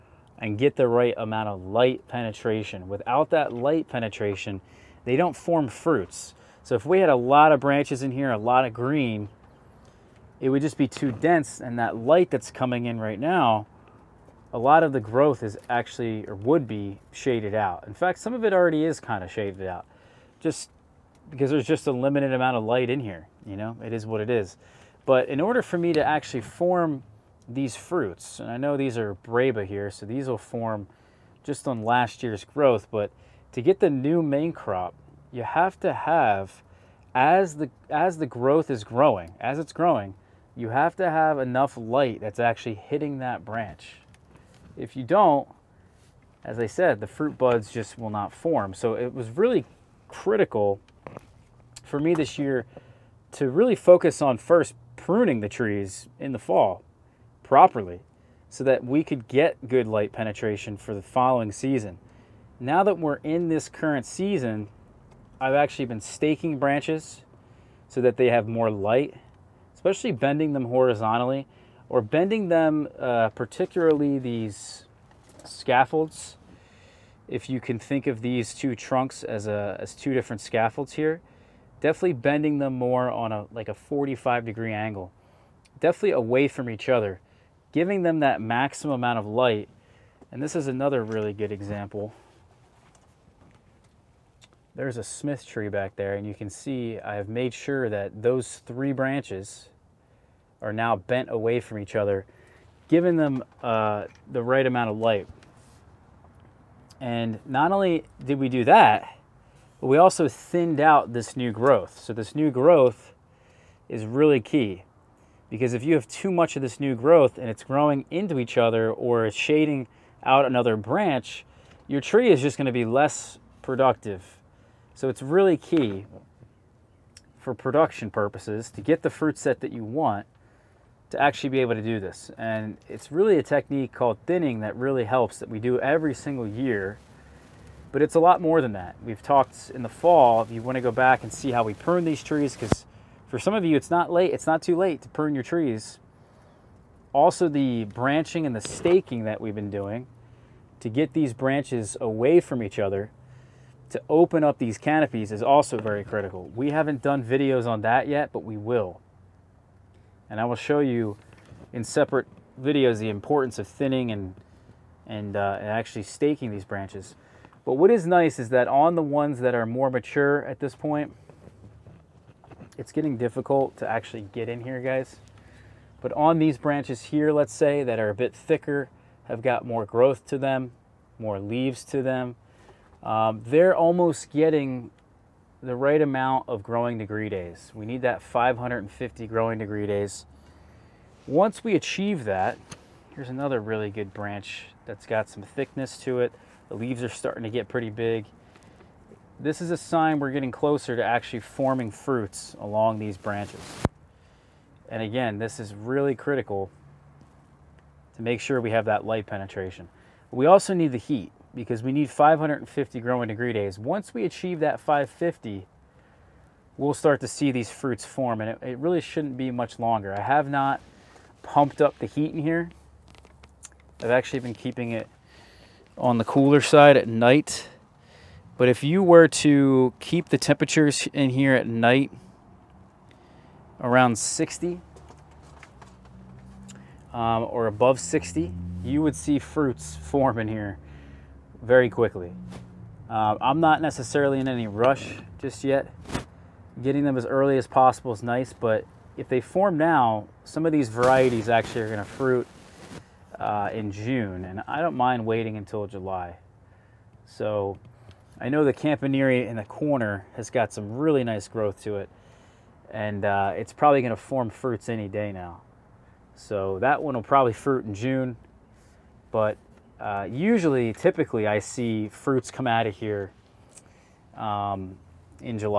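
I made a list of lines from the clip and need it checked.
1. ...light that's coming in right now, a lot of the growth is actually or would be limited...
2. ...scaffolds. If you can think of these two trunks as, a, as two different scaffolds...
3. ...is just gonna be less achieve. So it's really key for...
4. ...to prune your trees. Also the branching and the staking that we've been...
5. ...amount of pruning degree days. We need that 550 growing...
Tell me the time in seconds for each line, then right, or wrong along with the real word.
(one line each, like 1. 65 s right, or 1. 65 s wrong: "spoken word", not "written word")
1. 11 s wrong: "shaded", not "limited"
2. 75 s right
3. 122 s wrong: "productive", not "achieve"
4. 145 s right
5. 186 s wrong: "growing", not "pruning".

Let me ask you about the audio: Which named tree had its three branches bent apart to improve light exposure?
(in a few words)
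Smith.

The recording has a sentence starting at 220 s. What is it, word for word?
I have not pumped up the heat in here.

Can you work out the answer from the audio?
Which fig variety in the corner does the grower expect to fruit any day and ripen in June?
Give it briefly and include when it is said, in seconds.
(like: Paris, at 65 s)
Campanile, at 258 s.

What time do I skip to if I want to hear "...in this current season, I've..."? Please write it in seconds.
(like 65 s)
63 s.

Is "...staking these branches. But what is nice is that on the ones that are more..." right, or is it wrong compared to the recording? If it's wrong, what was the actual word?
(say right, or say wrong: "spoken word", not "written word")
right.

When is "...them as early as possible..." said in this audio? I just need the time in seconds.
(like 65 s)
247 s.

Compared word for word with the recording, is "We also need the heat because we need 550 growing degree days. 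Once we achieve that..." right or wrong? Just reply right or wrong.
right.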